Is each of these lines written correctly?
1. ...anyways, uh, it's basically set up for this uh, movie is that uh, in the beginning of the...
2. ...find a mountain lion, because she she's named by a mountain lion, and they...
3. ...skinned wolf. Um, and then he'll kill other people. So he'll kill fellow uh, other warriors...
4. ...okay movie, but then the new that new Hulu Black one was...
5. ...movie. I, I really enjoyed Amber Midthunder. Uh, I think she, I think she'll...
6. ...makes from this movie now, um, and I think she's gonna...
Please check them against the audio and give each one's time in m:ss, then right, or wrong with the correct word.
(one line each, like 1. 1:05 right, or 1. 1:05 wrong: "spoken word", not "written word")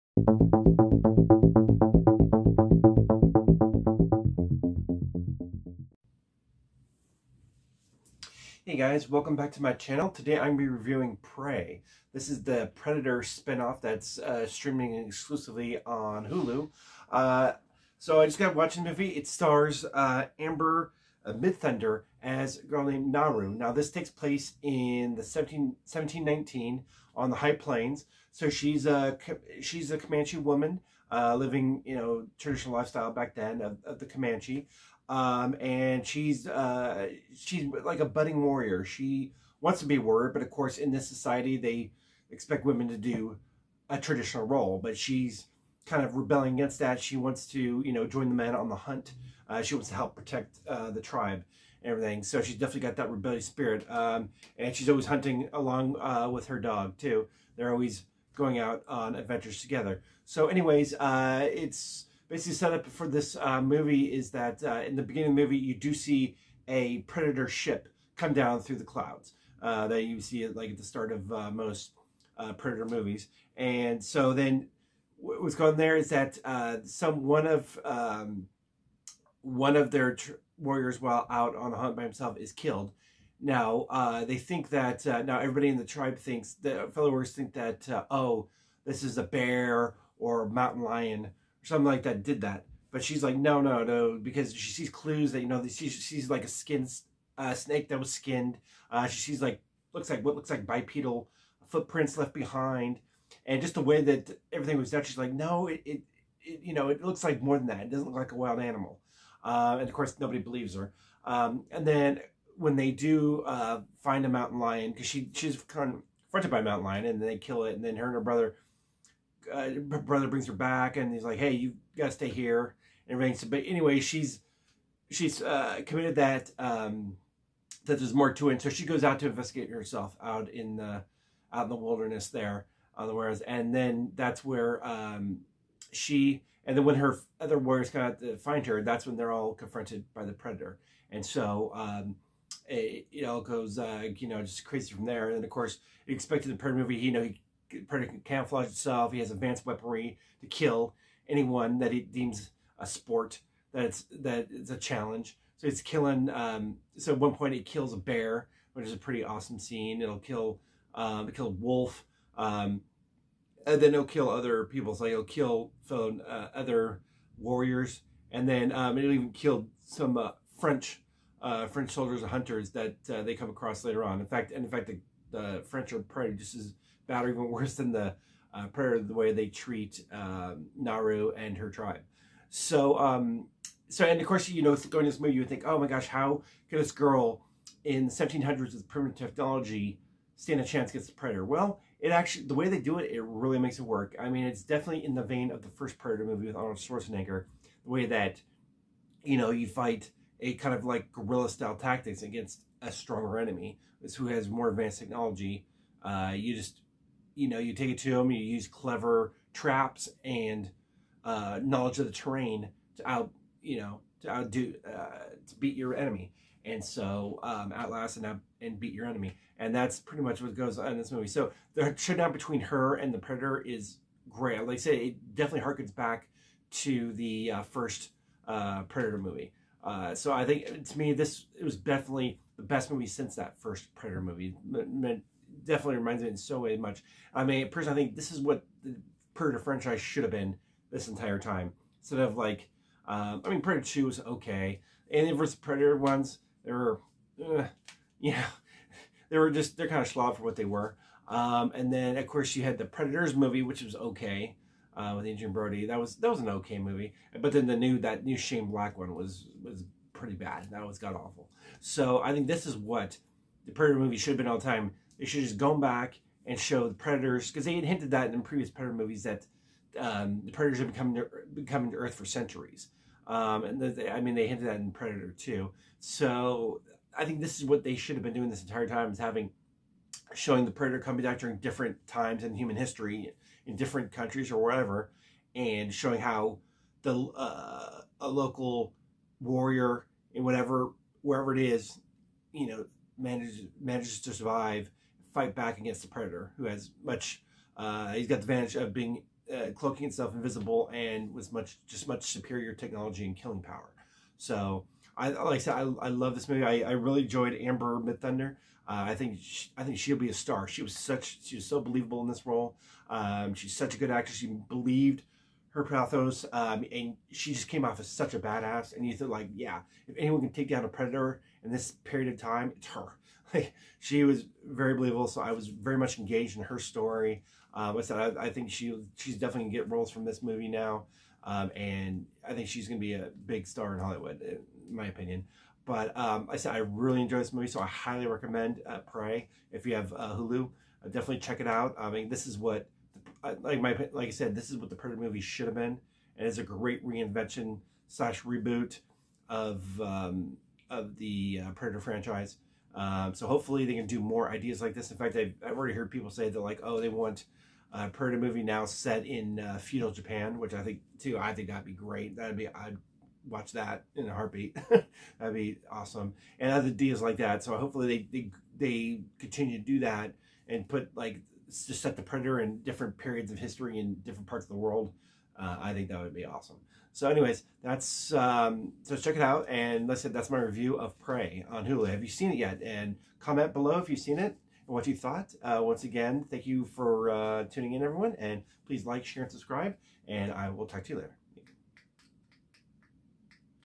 1. 1:00 right
2. 1:54 wrong: "confronted", not "named"
3. 2:41 wrong: "killed", not "skinned"
4. 4:16 wrong: "Shane", not "Hulu"
5. 5:06 right
6. 5:29 wrong: "roles", not "makes".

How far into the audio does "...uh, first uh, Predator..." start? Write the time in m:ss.
3:47.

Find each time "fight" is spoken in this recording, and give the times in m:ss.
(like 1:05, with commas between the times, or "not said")
3:19, 4:55.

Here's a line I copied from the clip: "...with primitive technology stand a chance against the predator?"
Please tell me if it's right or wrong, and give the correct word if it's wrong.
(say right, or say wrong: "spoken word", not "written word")
right.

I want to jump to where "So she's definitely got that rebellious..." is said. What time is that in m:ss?
0:52.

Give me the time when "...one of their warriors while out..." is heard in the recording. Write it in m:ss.
1:19.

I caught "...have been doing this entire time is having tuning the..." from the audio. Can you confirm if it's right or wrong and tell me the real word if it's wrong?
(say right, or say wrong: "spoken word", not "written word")
wrong: "showing", not "tuning".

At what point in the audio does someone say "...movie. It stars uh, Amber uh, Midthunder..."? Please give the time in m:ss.
0:18.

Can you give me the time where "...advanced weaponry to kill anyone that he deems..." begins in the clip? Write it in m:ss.
2:29.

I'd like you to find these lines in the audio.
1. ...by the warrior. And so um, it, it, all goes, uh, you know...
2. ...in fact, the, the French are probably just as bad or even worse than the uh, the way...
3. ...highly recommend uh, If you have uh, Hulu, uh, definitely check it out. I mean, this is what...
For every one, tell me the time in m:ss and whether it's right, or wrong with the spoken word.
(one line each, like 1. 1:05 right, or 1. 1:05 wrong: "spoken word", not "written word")
1. 2:20 wrong: "predator", not "warrior"
2. 2:54 right
3. 5:37 right.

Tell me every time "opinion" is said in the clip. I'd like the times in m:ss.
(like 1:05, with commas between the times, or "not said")
5:35.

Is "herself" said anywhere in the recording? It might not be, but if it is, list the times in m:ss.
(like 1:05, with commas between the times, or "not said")
2:09.